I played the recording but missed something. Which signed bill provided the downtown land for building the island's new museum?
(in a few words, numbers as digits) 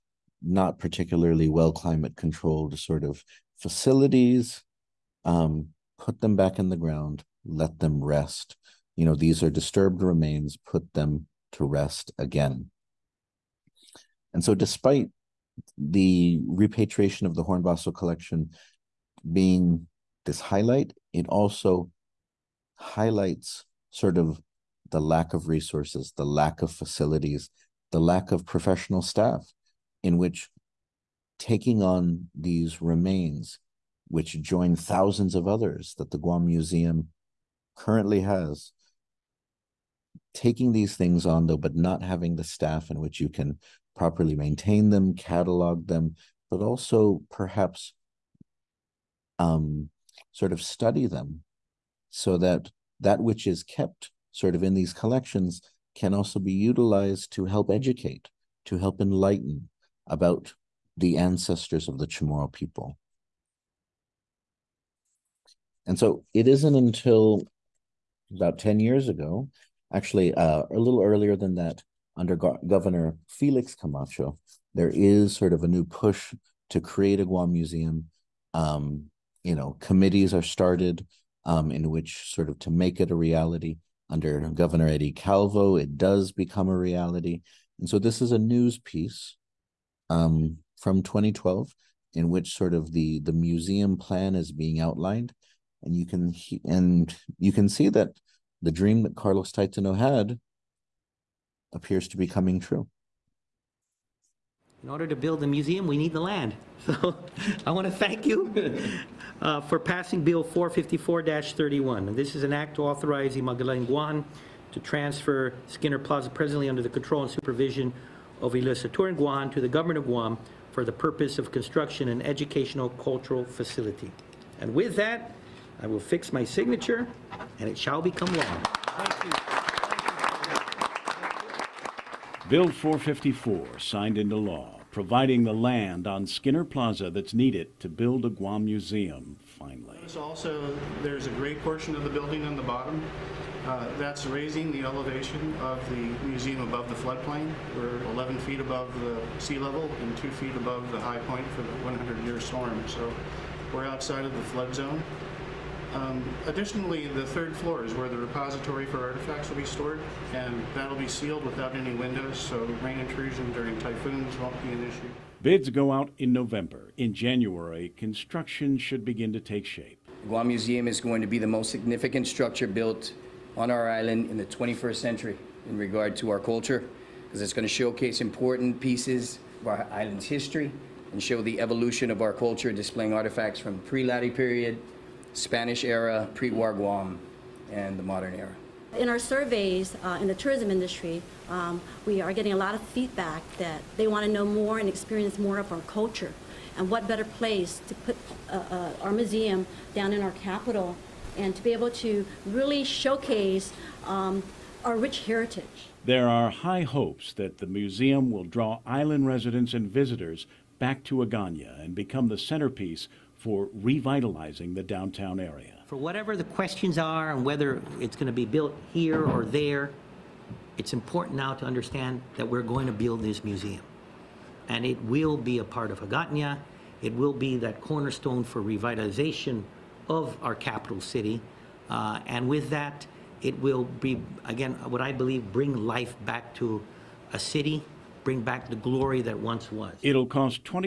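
Bill 454-31.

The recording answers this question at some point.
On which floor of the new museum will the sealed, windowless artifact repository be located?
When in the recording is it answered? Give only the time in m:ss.
2:37.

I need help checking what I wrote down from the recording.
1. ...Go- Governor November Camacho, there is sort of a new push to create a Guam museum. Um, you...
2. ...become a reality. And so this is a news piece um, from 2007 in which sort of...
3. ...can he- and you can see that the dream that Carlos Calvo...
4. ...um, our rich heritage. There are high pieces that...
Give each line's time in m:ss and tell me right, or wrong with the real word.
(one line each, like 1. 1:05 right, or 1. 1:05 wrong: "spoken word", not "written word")
1. 1:12 wrong: "Felix", not "November"
2. 1:26 wrong: "2012", not "2007"
3. 1:36 wrong: "Taitano", not "Calvo"
4. 3:24 wrong: "hopes", not "pieces".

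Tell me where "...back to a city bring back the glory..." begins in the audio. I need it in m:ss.
3:56.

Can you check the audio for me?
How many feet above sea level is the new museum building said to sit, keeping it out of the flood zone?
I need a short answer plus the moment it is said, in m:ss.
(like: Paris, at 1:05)
11 feet, at 2:28.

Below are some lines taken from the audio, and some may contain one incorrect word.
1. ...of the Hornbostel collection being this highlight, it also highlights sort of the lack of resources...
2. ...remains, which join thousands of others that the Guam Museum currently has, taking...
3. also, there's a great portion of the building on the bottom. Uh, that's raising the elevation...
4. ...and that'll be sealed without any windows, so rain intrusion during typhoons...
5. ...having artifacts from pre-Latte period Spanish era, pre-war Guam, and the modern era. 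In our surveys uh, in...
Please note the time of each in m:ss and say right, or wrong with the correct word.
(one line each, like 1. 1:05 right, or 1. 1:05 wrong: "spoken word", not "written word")
1. 0:17 right
2. 0:32 right
3. 2:20 right
4. 2:40 right
5. 3:02 wrong: "displaying", not "having".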